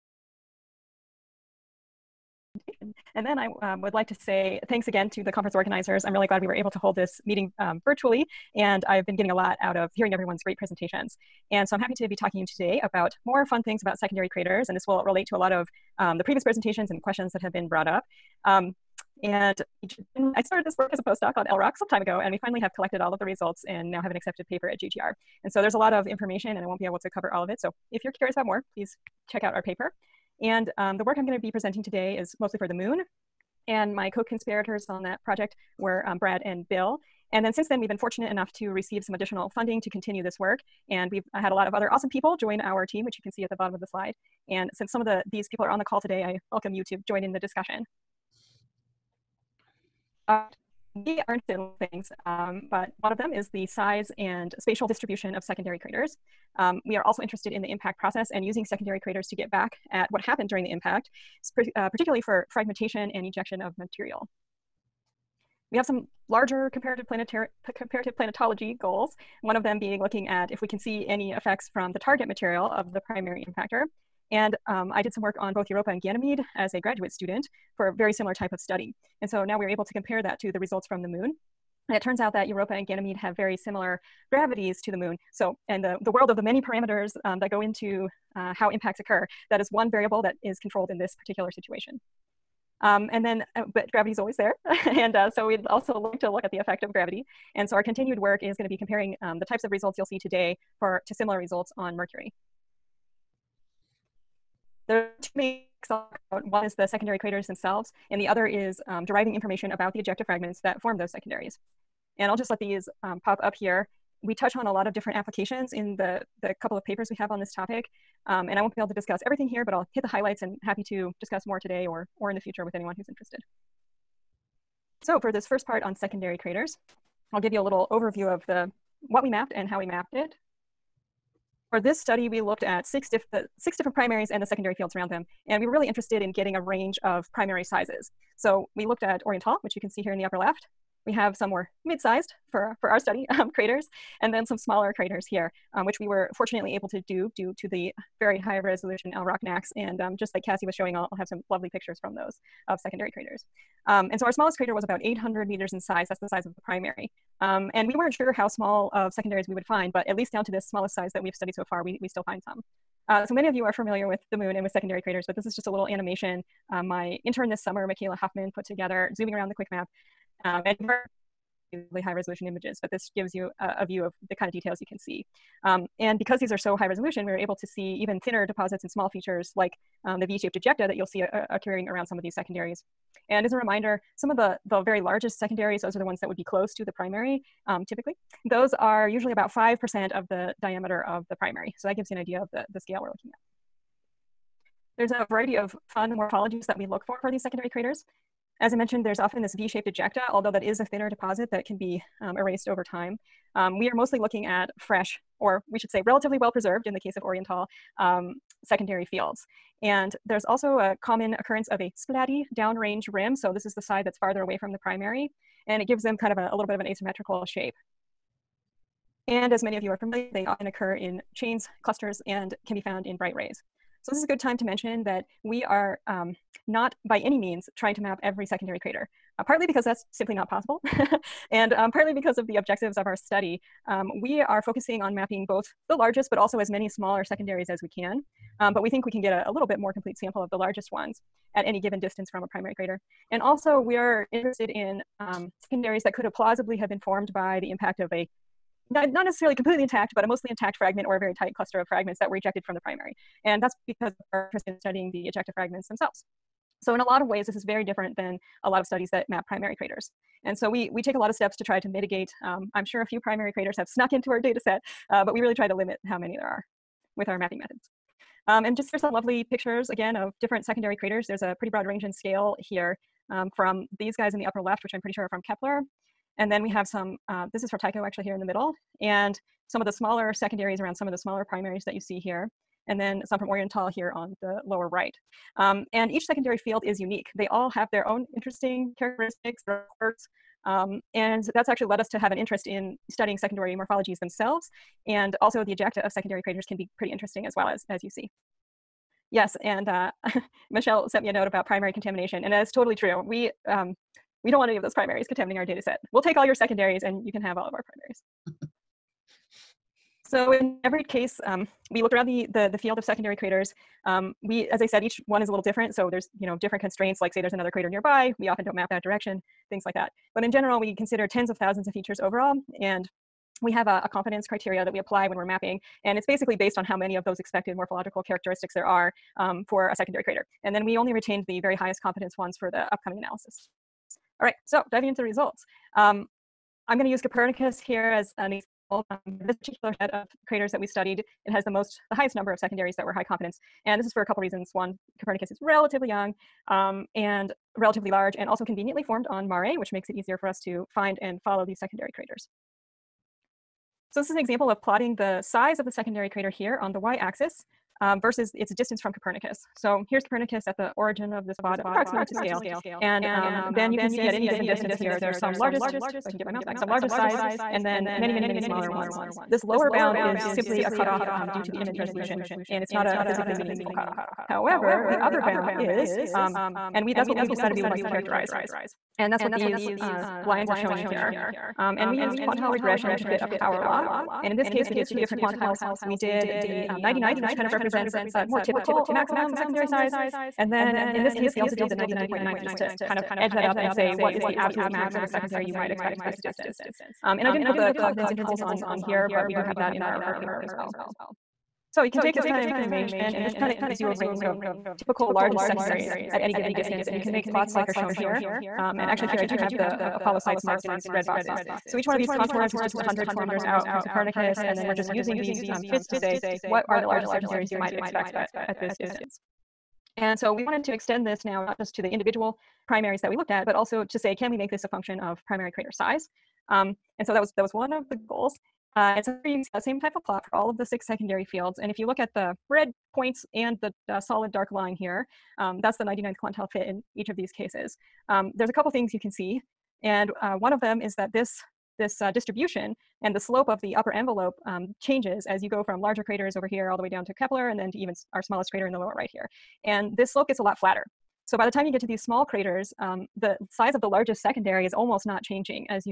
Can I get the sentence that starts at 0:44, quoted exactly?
And since some of the, these people are on the call today, I welcome you to join in the discussion.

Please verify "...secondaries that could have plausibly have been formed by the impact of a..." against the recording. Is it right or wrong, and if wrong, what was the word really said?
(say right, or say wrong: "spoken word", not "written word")
right.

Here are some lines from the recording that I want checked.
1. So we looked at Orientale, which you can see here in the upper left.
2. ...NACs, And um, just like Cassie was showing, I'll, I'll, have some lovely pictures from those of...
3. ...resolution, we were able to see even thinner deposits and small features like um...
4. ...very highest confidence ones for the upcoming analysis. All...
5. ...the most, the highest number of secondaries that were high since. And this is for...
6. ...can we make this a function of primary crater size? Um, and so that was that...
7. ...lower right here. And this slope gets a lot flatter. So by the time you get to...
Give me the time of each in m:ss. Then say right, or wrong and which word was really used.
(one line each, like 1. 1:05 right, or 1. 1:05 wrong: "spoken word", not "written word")
1. 2:18 right
2. 2:29 right
3. 2:56 right
4. 5:31 right
5. 5:41 wrong: "confidence", not "since"
6. 7:04 right
7. 7:28 right.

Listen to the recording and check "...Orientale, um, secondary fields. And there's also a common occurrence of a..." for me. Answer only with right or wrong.
right.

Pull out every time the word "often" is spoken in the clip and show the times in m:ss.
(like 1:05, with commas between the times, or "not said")
3:19, 3:40, 5:18.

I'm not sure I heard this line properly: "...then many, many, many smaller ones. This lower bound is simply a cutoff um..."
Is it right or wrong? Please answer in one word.
right.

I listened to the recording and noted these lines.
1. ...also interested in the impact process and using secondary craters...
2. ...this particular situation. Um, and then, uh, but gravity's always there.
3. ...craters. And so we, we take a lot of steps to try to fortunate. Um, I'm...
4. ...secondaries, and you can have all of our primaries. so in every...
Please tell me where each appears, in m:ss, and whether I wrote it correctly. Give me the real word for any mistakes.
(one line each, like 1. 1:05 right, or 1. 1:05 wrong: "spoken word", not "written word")
1. 0:57 right
2. 1:30 right
3. 4:19 wrong: "mitigate", not "fortunate"
4. 5:06 right.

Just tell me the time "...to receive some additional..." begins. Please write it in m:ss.
0:38.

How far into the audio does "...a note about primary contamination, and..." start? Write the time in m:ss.
5:01.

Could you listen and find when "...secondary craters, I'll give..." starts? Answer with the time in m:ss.
2:05.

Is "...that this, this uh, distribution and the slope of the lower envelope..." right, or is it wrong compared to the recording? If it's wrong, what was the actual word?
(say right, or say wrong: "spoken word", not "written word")
wrong: "upper", not "lower".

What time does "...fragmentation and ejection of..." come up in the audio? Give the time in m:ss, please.
1:02.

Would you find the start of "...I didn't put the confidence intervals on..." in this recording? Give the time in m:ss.
6:37.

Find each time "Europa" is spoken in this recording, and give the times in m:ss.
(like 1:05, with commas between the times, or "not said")
1:15, 1:22.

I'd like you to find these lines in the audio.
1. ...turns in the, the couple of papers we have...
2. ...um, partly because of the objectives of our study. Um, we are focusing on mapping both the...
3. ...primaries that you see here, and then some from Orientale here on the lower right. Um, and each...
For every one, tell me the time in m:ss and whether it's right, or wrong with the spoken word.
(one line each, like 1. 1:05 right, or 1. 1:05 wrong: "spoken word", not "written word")
1. 1:55 wrong: "applications", not "turns"
2. 3:51 right
3. 4:41 right.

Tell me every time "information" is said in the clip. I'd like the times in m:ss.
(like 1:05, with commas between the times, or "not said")
0:26, 1:49, 6:42.